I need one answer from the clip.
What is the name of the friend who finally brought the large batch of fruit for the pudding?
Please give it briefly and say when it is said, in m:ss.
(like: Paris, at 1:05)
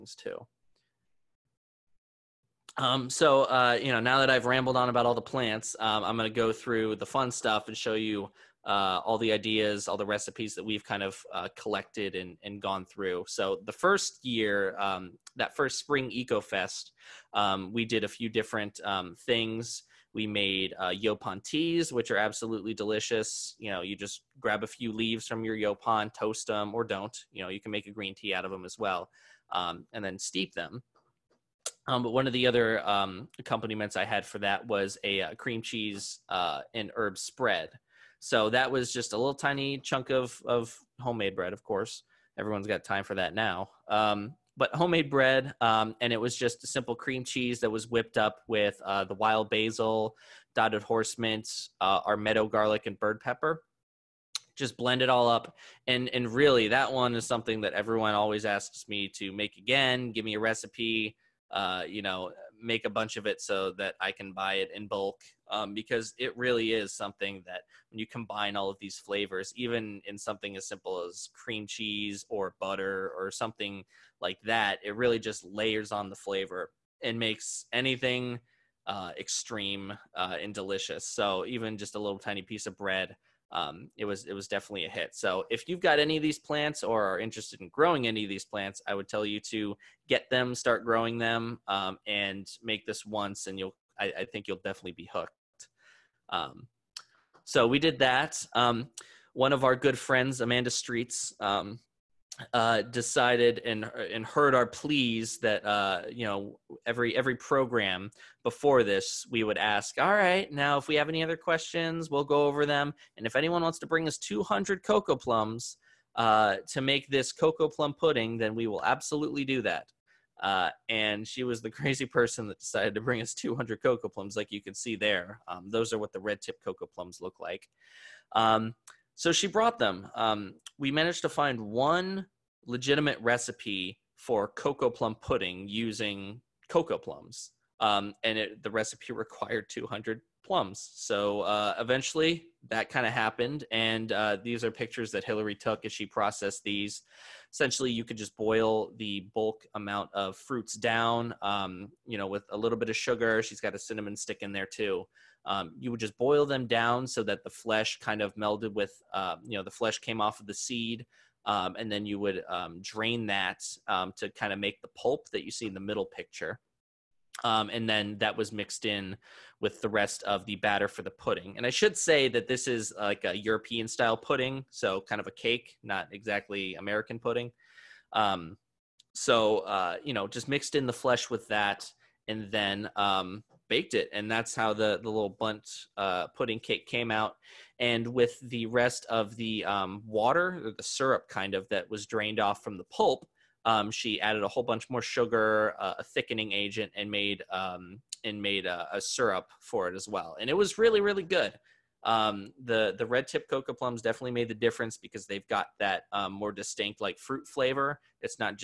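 Amanda Streets, at 1:40.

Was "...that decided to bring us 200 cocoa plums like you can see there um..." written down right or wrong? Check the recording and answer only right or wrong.
right.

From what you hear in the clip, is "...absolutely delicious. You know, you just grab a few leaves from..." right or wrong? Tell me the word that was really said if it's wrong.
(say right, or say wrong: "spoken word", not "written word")
right.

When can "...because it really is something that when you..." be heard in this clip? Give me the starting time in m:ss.
1:05.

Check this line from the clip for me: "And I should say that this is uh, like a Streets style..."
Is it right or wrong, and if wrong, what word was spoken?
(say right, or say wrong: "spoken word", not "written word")
wrong: "European", not "Streets".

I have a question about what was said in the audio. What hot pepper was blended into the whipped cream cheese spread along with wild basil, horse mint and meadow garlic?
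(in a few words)
Bird pepper.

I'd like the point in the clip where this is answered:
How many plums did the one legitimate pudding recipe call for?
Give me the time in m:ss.
2:19.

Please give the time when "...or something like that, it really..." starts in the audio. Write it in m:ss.
1:13.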